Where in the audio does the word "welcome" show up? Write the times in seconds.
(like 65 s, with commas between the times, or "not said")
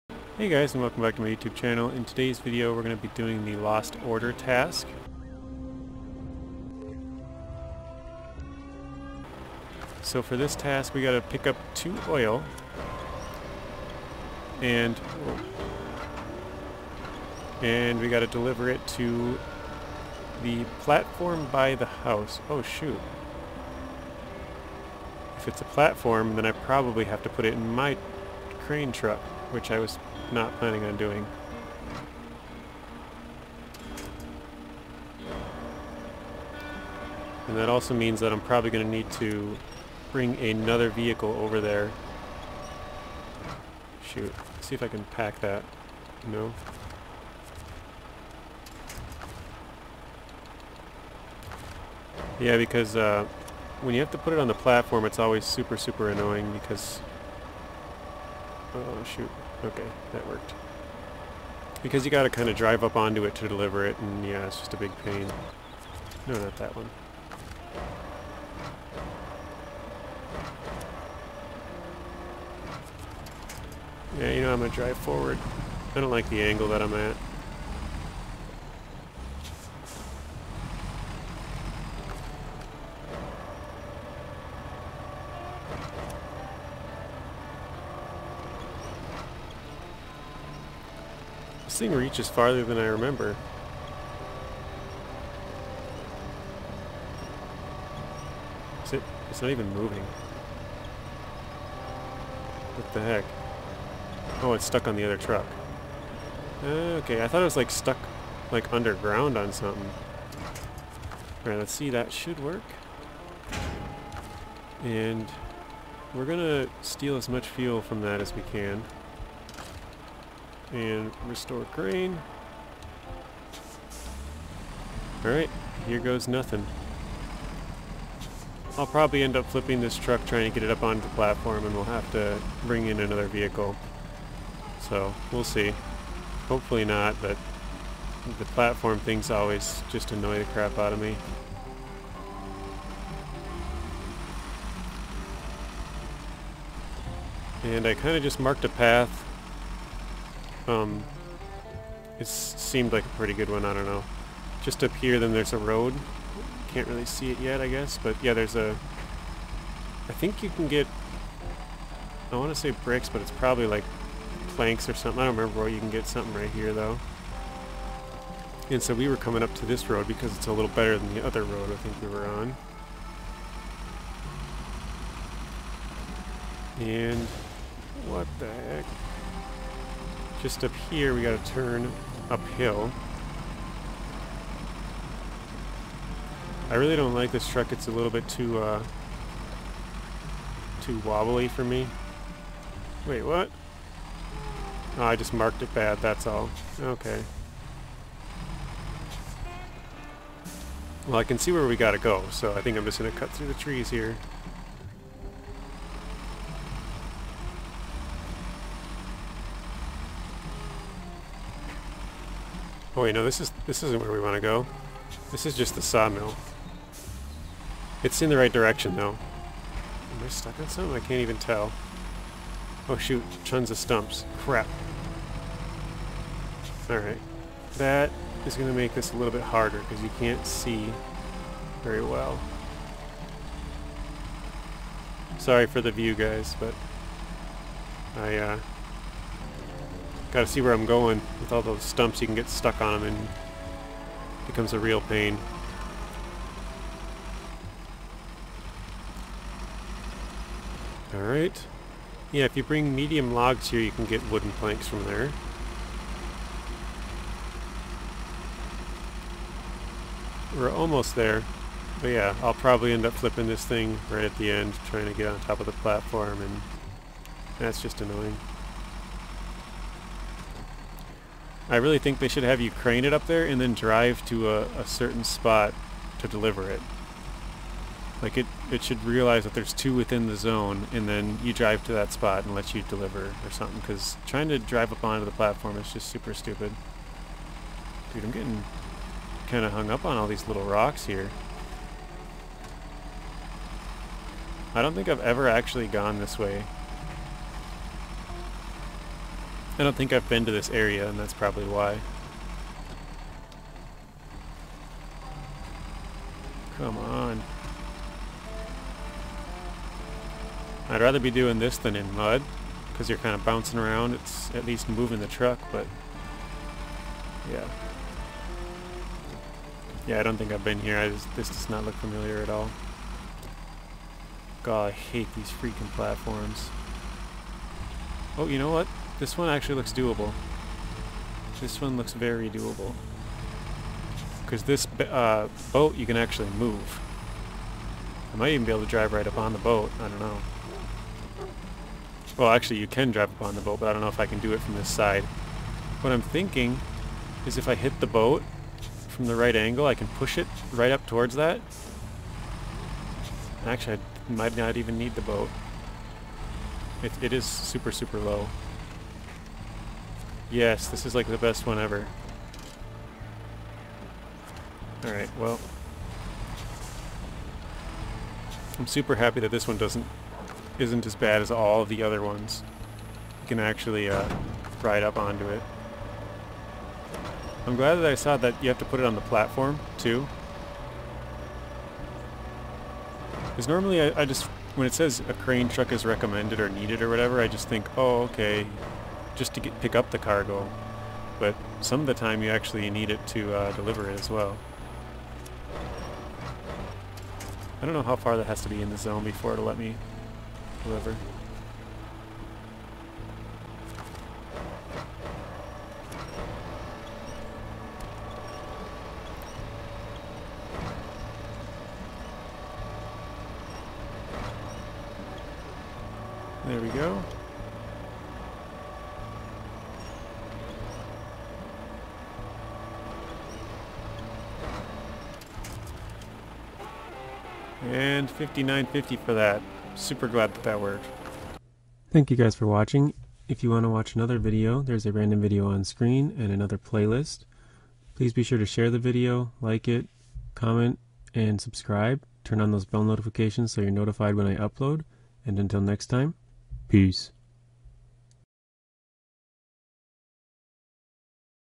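0 s.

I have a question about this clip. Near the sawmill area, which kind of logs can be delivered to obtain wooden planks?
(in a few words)
Medium logs.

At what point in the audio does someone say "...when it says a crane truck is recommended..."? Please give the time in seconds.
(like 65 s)
384 s.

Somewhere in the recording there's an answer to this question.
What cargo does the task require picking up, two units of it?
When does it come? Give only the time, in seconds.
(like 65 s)
11 s.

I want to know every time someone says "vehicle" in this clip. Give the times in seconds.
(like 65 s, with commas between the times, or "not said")
40 s, 133 s.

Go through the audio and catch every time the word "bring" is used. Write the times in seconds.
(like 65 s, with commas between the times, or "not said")
40 s, 132 s, 252 s.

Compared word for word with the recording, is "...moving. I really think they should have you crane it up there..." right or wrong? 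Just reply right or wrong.
wrong.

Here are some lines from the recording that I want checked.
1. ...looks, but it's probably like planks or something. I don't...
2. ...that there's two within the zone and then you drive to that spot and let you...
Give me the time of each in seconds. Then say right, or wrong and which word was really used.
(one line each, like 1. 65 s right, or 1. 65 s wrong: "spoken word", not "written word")
1. 162 s wrong: "bricks", not "looks"
2. 279 s right.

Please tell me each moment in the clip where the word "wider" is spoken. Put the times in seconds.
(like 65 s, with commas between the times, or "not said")
not said.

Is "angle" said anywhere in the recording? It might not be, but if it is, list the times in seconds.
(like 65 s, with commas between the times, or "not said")
76 s, 349 s.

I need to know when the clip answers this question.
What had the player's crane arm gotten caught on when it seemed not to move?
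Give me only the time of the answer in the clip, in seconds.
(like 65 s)
104 s.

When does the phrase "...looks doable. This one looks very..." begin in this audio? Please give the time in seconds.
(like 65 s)
329 s.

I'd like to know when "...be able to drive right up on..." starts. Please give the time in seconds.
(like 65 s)
338 s.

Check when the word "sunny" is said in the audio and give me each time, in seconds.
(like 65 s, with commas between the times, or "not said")
not said.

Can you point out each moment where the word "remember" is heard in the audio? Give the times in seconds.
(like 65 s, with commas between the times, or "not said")
92 s, 165 s.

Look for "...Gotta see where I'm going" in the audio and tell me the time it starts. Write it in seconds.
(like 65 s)
240 s.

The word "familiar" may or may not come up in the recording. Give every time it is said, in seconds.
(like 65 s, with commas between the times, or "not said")
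321 s.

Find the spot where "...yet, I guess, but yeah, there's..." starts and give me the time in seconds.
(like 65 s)
157 s.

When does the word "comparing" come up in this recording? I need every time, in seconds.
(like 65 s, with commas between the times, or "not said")
not said.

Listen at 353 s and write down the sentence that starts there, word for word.
Actually, I might not even need the boat.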